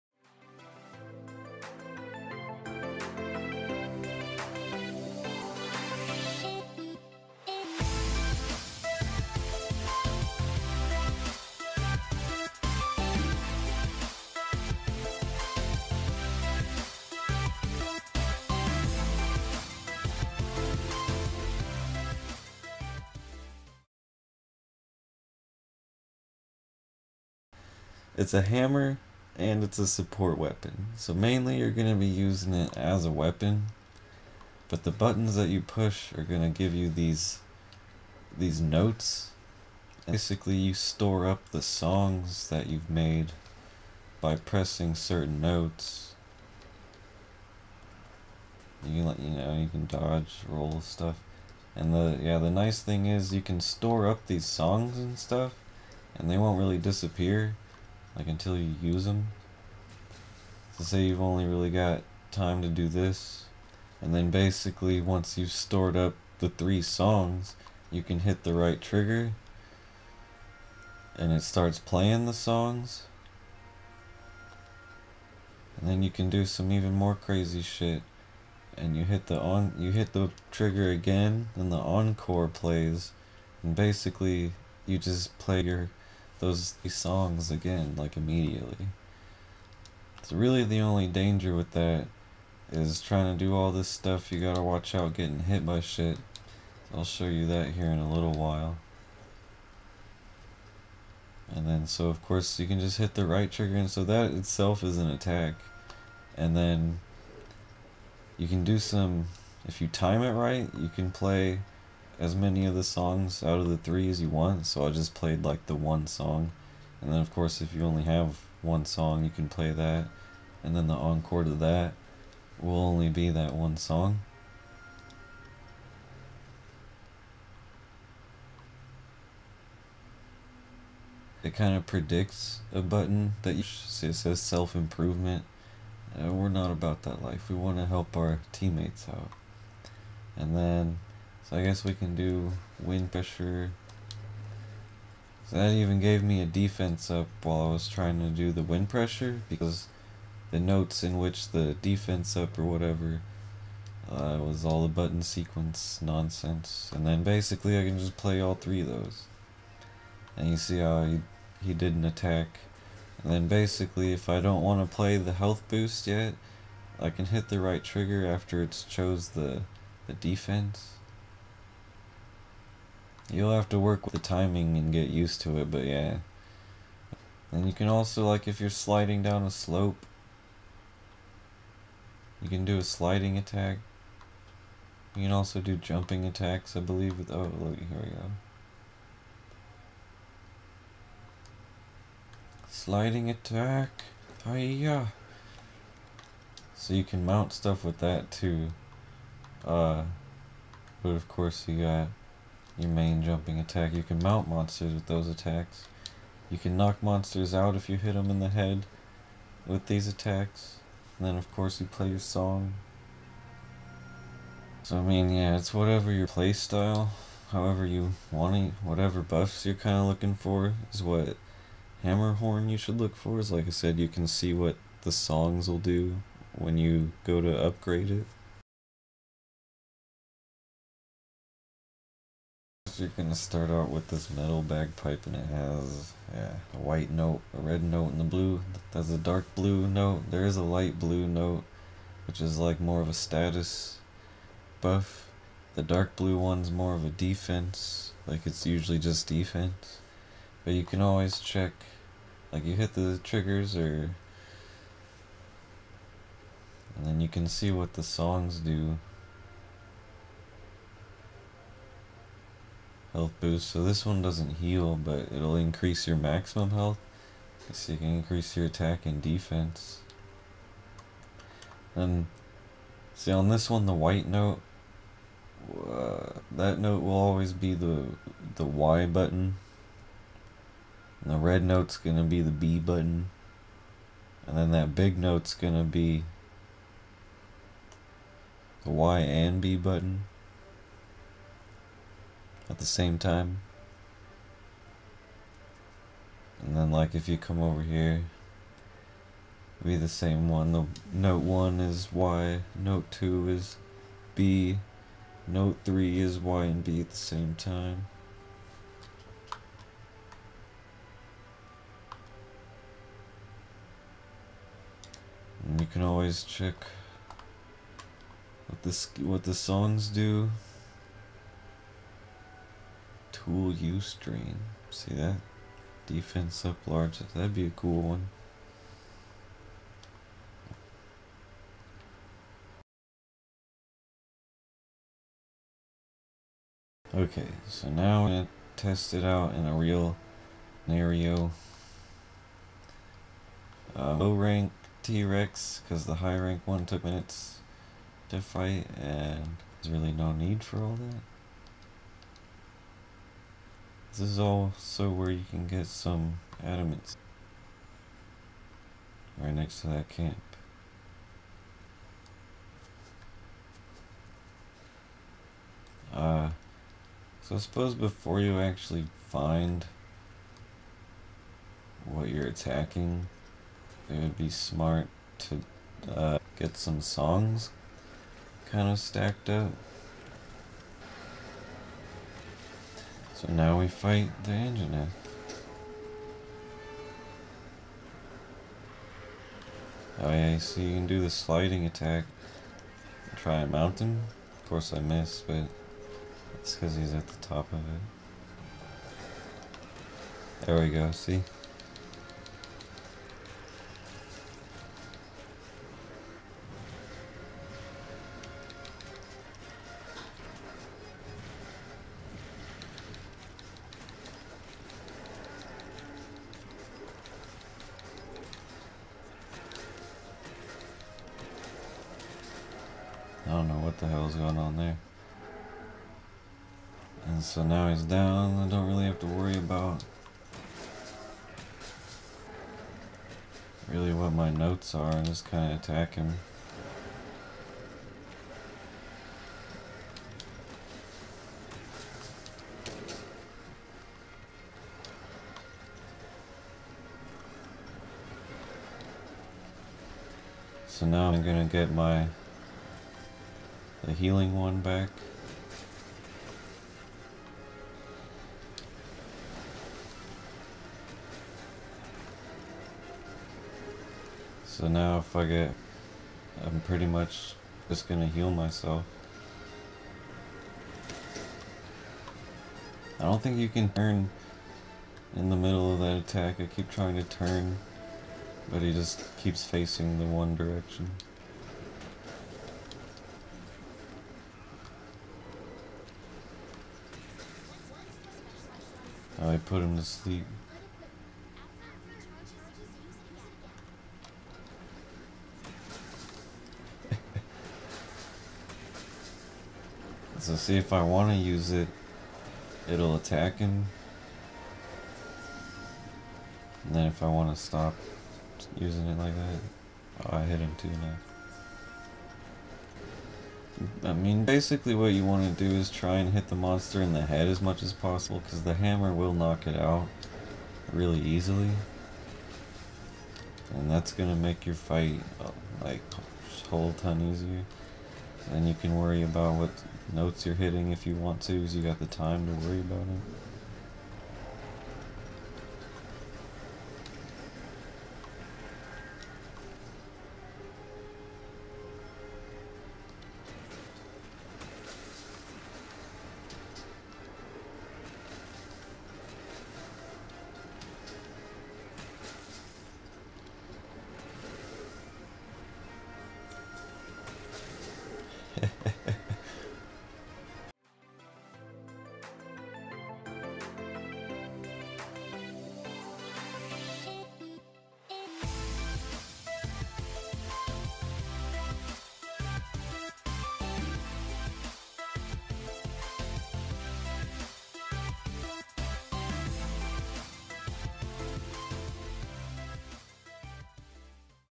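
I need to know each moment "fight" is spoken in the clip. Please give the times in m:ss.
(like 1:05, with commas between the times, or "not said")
5:48, 6:23, 8:44.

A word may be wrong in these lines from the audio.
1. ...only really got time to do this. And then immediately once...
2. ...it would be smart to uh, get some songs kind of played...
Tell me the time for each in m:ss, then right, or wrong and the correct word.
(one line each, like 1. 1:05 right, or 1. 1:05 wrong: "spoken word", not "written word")
1. 1:01 wrong: "basically", not "immediately"
2. 6:14 wrong: "stacked", not "played".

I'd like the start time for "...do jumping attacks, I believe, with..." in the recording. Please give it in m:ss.
3:05.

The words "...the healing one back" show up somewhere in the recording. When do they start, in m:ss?
7:34.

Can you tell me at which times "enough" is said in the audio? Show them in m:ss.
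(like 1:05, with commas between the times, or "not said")
not said.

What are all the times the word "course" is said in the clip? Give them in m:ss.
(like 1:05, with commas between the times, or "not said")
1:42, 1:57, 3:21, 3:31, 6:34.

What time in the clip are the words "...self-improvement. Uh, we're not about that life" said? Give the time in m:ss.
2:14.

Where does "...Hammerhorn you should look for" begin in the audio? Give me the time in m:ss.
3:42.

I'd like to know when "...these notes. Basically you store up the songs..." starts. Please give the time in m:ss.
0:38.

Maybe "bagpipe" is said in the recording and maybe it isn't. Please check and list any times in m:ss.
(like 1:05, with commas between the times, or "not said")
3:54.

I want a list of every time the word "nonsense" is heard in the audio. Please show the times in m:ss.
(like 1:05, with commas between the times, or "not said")
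2:36.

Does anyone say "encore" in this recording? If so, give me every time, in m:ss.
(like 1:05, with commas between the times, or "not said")
1:21, 2:00.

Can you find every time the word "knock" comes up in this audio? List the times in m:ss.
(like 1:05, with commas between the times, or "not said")
3:26, 8:39.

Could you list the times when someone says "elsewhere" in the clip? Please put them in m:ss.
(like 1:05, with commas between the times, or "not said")
not said.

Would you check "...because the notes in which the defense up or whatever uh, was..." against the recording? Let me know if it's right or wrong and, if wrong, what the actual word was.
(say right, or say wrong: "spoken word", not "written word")
right.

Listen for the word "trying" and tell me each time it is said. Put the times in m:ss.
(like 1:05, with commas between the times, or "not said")
1:33, 2:27, 7:56.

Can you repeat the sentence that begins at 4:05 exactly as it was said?
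The dark blue one's more of a defense, like it's usually just defense.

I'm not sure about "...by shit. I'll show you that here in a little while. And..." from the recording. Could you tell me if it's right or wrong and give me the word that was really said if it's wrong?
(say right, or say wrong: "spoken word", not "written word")
right.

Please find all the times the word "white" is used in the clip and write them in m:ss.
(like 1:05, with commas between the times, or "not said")
3:56, 4:33.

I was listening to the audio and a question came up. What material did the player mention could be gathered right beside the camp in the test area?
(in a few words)
adamants.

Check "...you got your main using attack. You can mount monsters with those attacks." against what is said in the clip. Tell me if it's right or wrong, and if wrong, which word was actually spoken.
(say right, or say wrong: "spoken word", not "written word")
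wrong: "jumping", not "using".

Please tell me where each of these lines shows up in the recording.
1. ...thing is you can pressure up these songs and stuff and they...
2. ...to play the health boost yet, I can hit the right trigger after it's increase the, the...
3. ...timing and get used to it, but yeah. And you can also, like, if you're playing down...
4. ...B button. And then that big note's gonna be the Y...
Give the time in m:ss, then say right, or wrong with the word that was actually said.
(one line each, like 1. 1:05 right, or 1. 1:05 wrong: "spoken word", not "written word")
1. 0:52 wrong: "store", not "pressure"
2. 2:44 wrong: "chose", not "increase"
3. 2:54 wrong: "sliding", not "playing"
4. 4:42 right.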